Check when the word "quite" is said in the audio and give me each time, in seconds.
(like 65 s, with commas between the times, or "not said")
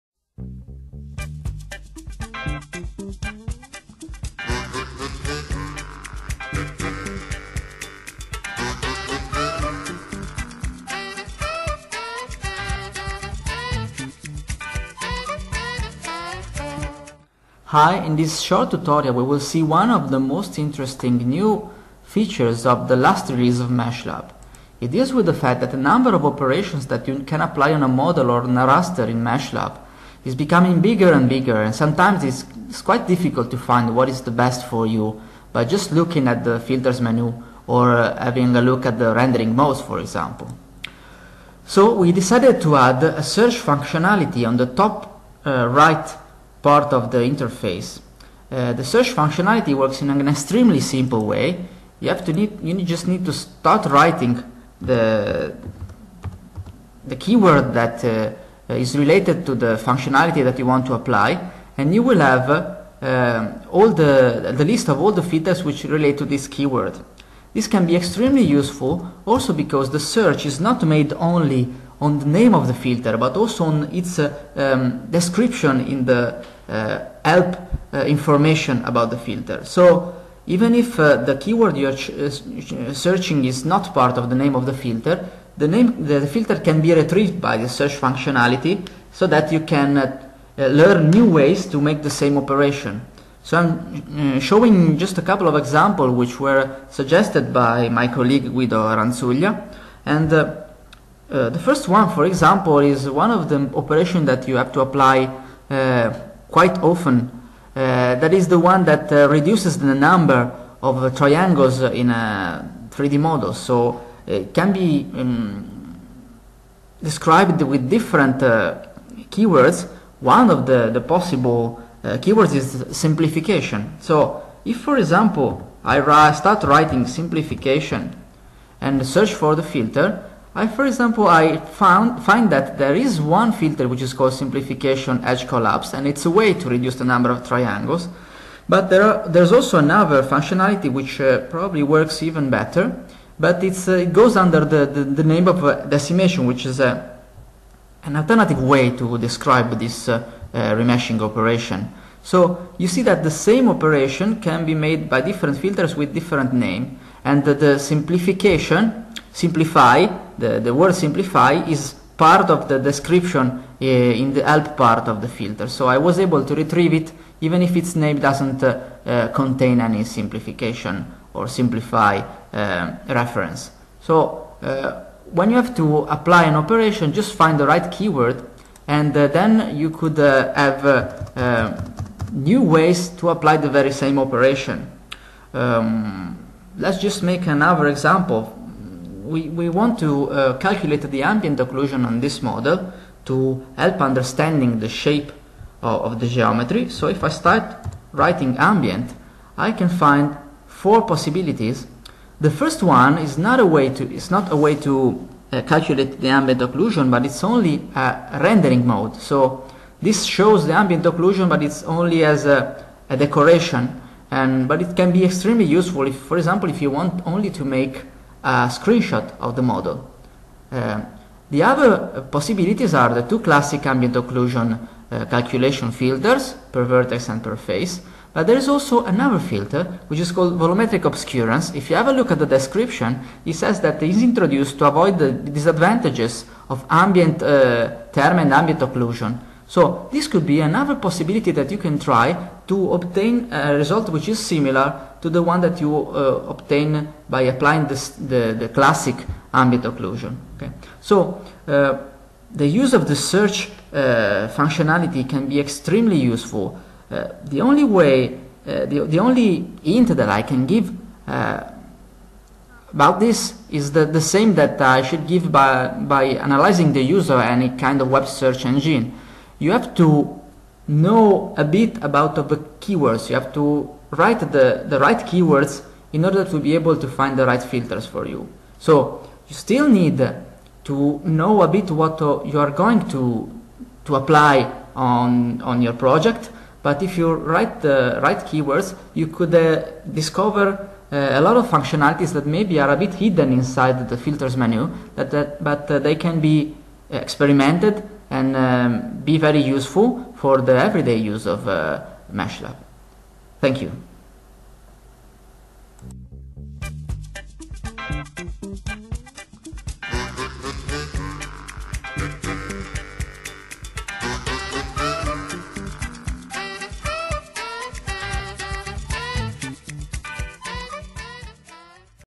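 32 s, 106 s.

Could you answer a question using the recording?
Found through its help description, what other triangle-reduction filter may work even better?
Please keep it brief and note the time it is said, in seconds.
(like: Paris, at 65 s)
Decimation, at 145 s.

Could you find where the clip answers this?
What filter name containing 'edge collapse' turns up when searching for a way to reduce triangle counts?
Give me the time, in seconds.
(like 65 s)
134 s.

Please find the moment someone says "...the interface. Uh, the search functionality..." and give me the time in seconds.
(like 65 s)
47 s.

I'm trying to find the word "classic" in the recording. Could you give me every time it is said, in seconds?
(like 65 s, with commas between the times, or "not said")
223 s, 248 s.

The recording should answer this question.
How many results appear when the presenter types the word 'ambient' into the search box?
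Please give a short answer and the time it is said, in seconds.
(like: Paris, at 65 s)
4, at 200 s.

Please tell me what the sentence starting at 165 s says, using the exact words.
So I was able to retrieve it even if its name doesn't contain any simplification or simplify uh, reference.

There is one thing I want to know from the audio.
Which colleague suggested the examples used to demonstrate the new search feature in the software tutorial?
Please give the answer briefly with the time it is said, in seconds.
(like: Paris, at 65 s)
Guido Ranzuglia, at 98 s.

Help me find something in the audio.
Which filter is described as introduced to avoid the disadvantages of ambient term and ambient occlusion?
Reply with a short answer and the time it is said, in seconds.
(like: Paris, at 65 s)
Volumetric obscurance, at 230 s.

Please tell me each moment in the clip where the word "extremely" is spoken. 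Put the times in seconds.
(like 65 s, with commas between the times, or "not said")
50 s, 67 s, 215 s, 255 s.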